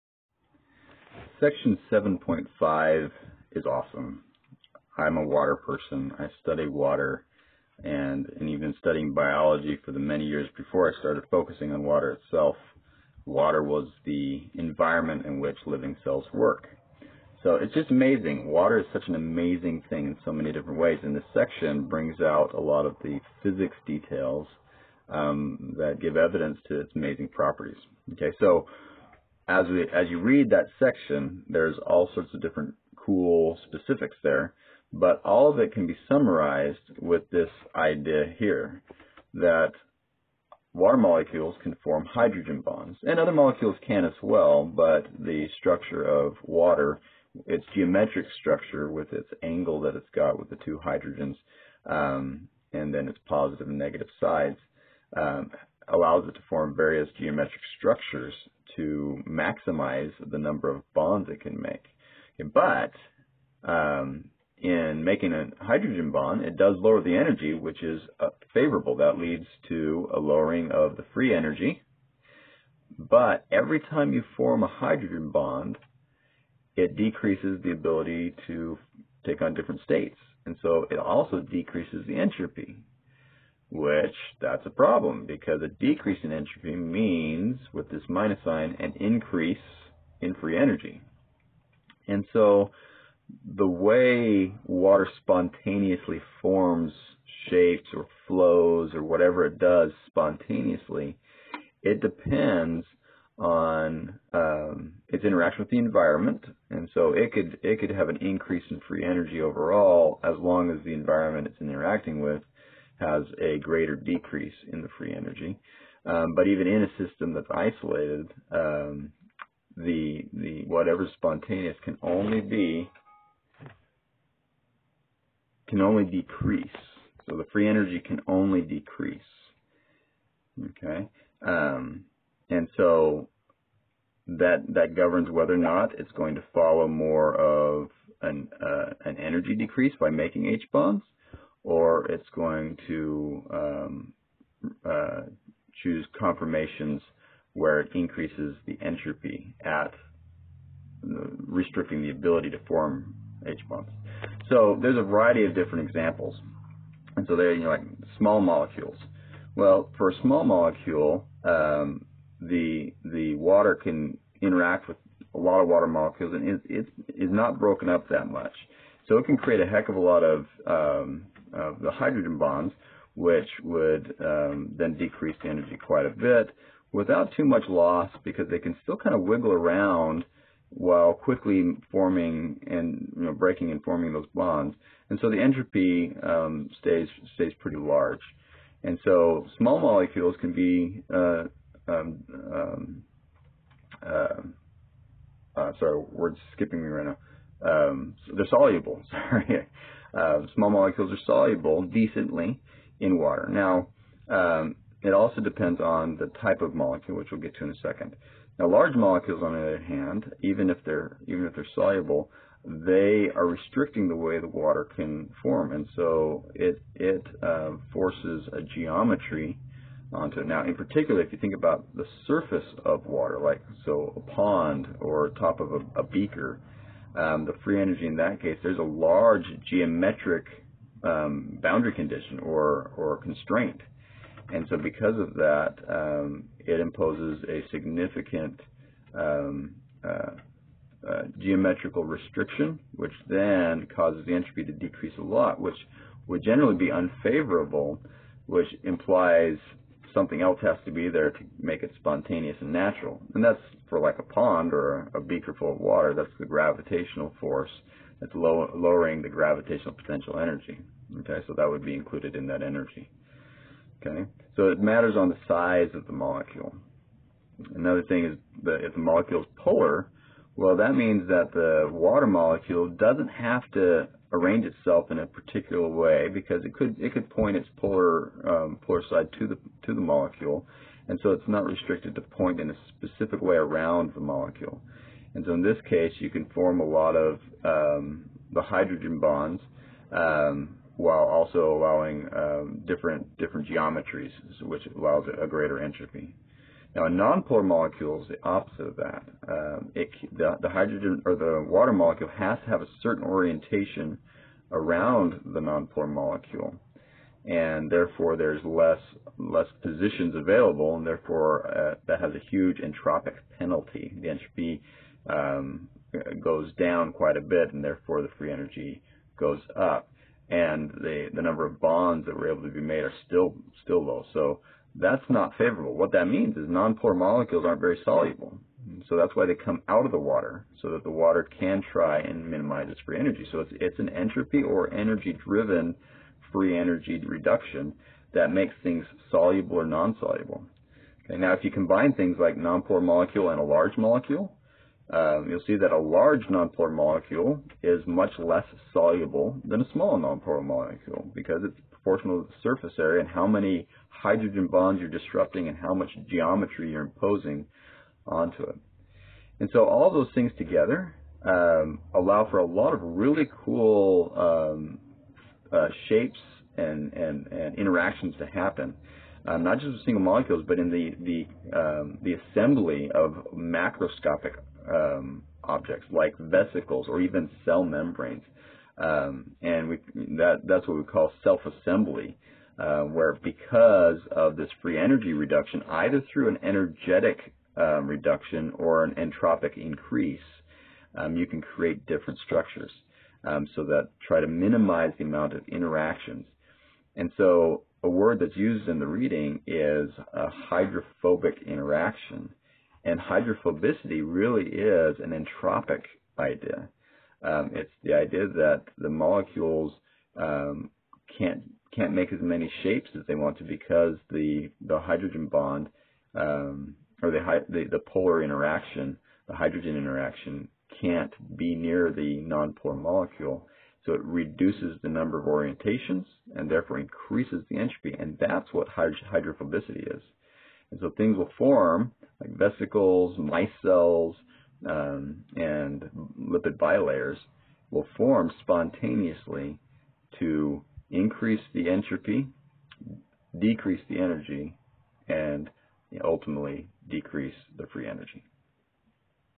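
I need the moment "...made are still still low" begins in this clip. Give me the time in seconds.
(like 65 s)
322 s.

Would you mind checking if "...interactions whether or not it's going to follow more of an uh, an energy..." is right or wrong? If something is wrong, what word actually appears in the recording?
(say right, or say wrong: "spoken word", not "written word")
wrong: "governs", not "interactions".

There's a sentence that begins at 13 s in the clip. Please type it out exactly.
Water was the environment in which living cells work.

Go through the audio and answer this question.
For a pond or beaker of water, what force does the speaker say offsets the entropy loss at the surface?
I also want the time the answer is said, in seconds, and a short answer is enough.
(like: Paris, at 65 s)
gravitational force, at 256 s.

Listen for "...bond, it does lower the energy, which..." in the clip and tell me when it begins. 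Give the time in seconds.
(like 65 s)
66 s.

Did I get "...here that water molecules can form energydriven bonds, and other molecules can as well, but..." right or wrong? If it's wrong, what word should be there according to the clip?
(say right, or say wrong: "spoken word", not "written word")
wrong: "hydrogen", not "energydriven".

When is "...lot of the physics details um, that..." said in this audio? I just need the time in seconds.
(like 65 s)
22 s.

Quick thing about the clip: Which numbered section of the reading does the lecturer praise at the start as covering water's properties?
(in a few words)
7.5.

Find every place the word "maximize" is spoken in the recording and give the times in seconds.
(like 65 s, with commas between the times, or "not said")
59 s.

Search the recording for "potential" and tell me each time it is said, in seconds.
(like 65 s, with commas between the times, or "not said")
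259 s.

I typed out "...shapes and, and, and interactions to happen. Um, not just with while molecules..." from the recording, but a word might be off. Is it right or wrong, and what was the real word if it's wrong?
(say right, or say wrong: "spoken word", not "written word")
wrong: "single", not "while".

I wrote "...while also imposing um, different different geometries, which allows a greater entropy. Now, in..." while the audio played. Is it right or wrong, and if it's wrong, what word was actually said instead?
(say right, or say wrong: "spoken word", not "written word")
wrong: "allowing", not "imposing".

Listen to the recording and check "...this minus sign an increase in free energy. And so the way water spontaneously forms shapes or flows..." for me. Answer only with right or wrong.
right.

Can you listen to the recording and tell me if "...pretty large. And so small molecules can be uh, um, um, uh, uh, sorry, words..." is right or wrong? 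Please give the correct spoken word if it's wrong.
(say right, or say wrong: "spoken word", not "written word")
right.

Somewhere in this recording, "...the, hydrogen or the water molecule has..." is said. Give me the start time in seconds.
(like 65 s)
300 s.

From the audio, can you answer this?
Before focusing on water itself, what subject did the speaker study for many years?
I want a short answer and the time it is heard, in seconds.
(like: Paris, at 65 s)
biology, at 9 s.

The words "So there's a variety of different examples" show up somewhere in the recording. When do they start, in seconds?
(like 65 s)
154 s.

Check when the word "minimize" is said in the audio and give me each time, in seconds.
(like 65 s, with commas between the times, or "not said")
332 s, 394 s.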